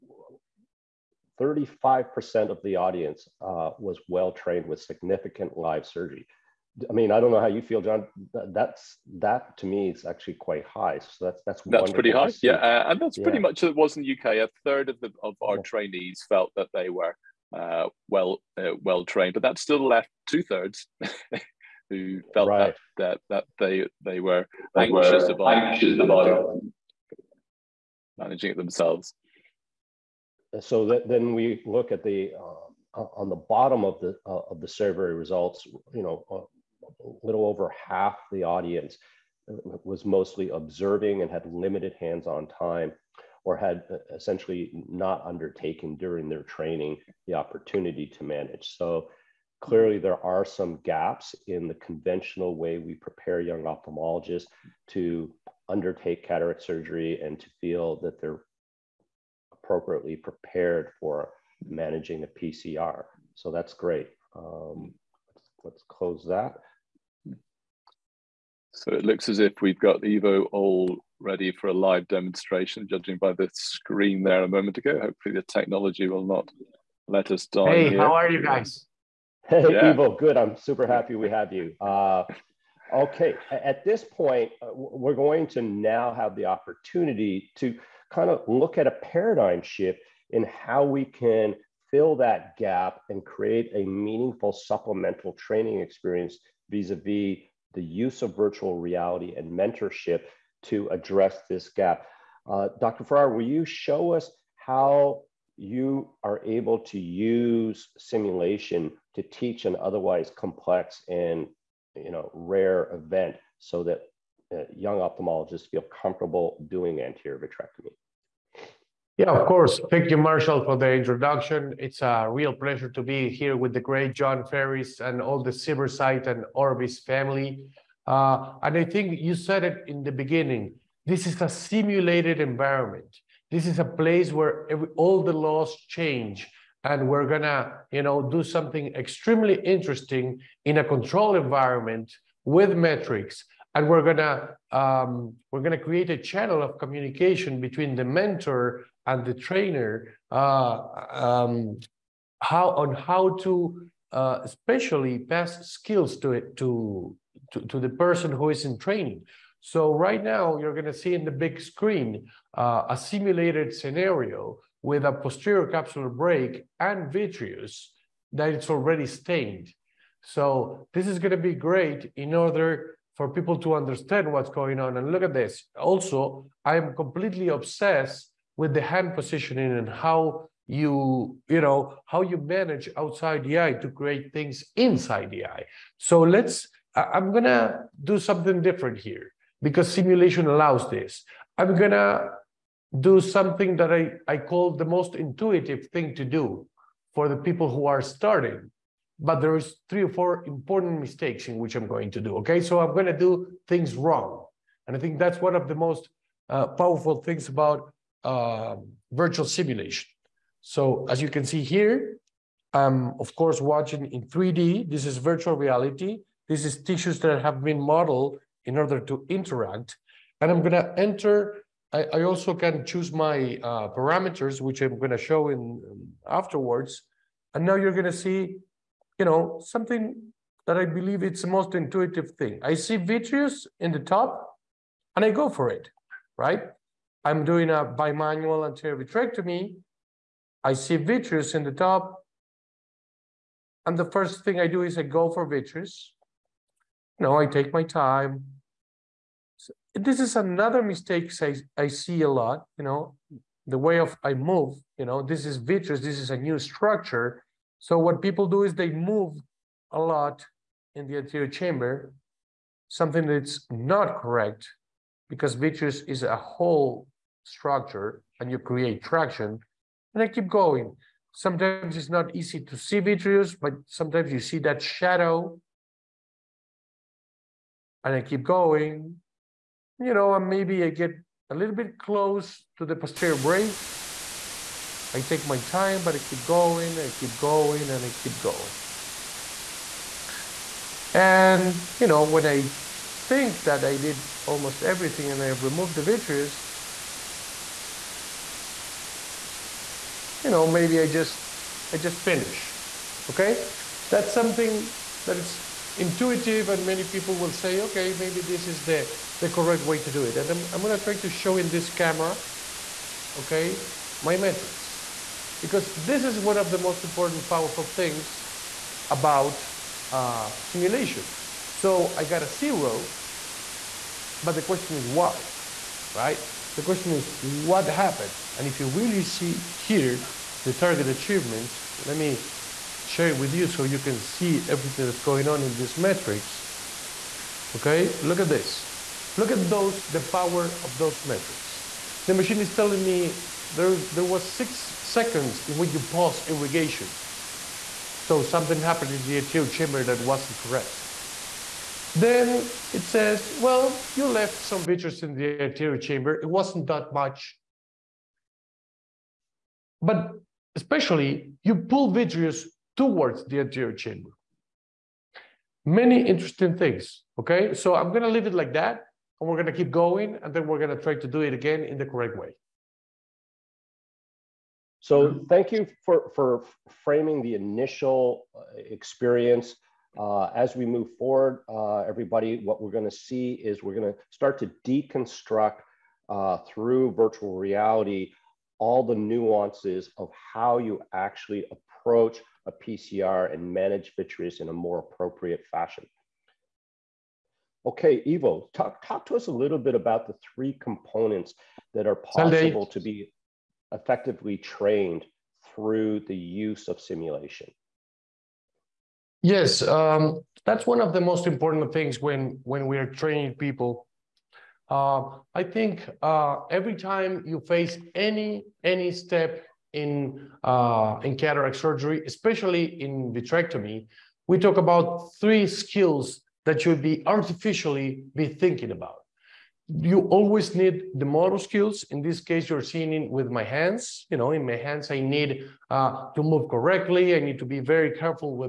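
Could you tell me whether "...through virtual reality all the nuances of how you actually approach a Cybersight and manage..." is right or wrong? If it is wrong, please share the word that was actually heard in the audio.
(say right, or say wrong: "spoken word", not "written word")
wrong: "PCR", not "Cybersight".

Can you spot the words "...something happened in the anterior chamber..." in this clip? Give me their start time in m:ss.
5:48.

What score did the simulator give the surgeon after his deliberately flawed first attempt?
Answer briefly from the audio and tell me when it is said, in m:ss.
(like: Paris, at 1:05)
Zero, at 5:22.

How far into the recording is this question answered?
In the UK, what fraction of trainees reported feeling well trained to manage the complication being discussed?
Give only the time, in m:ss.
0:14.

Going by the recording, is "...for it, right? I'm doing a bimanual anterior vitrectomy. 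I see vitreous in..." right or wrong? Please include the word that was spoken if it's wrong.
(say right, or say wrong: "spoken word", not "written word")
right.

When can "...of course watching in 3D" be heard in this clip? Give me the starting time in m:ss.
3:33.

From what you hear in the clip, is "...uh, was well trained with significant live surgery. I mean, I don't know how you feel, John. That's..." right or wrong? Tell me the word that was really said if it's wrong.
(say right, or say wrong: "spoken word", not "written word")
right.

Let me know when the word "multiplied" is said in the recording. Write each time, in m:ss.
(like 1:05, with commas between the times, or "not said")
not said.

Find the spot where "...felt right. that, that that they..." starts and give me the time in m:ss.
0:22.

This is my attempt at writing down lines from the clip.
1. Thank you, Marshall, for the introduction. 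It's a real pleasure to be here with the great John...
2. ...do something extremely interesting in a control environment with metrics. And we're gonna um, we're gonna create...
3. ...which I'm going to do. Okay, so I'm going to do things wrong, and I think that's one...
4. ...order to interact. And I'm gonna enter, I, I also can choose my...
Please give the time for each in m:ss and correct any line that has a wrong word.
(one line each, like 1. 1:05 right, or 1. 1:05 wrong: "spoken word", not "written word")
1. 1:59 right
2. 2:18 right
3. 3:21 right
4. 3:38 right.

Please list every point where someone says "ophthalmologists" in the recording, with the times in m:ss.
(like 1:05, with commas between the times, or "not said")
0:53, 1:54.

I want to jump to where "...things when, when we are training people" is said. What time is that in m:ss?
6:51.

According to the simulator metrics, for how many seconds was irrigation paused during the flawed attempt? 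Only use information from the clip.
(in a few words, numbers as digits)
6 seconds.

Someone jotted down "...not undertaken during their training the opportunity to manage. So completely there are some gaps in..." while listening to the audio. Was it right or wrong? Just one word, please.
wrong.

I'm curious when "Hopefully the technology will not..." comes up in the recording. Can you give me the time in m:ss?
1:15.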